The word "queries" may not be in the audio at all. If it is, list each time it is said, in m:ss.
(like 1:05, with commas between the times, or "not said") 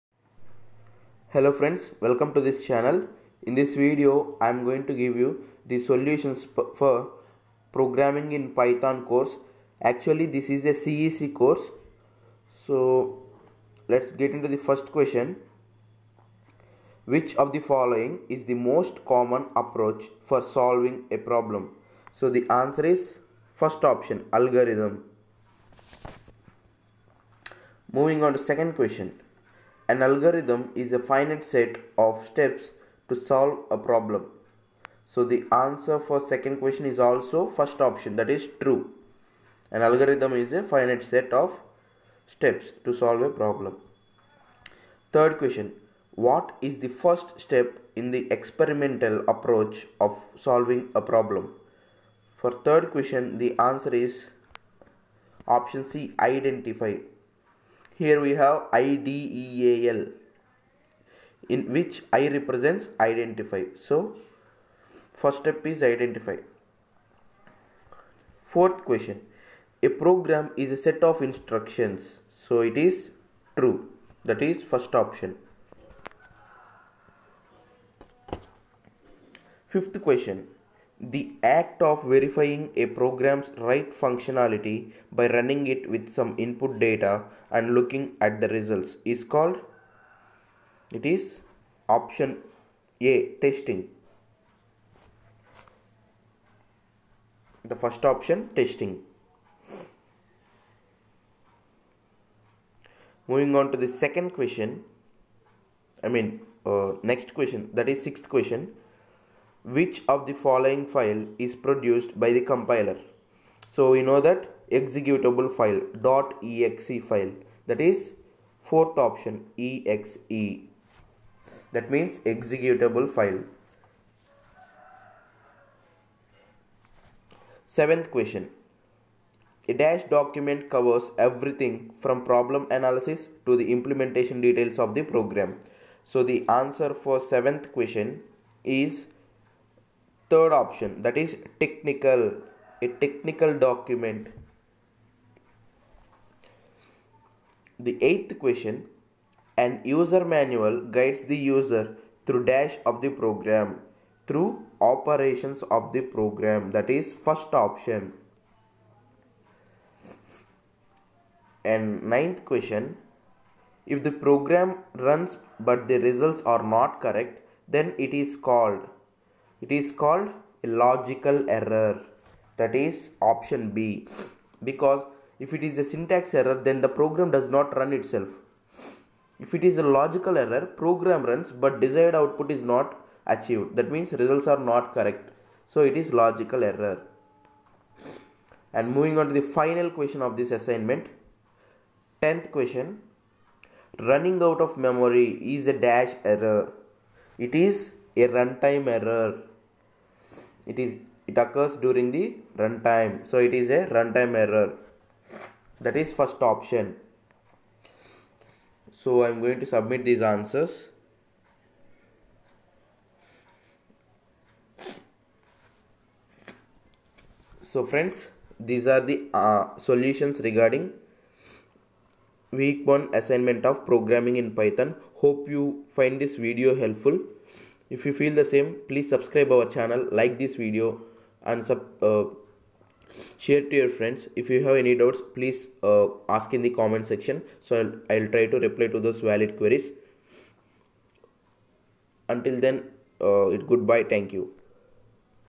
3:59.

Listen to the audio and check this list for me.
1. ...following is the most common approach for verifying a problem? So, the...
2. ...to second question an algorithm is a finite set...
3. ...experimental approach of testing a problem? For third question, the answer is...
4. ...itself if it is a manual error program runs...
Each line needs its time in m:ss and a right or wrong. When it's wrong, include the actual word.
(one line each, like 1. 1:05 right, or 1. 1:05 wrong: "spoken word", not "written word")
1. 0:17 wrong: "solving", not "verifying"
2. 0:28 right
3. 0:48 wrong: "solving", not "testing"
4. 2:57 wrong: "logical", not "manual".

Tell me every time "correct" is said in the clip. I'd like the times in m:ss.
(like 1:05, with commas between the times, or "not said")
2:47, 3:04.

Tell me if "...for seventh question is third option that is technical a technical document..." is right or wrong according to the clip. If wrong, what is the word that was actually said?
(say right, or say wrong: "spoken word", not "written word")
right.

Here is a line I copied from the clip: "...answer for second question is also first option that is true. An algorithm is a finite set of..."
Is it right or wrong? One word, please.
right.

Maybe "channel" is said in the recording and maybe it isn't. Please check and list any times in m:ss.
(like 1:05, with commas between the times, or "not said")
0:02, 3:49.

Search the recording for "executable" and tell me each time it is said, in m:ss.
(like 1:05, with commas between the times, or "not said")
1:54, 2:02.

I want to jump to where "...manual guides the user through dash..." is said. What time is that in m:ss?
2:30.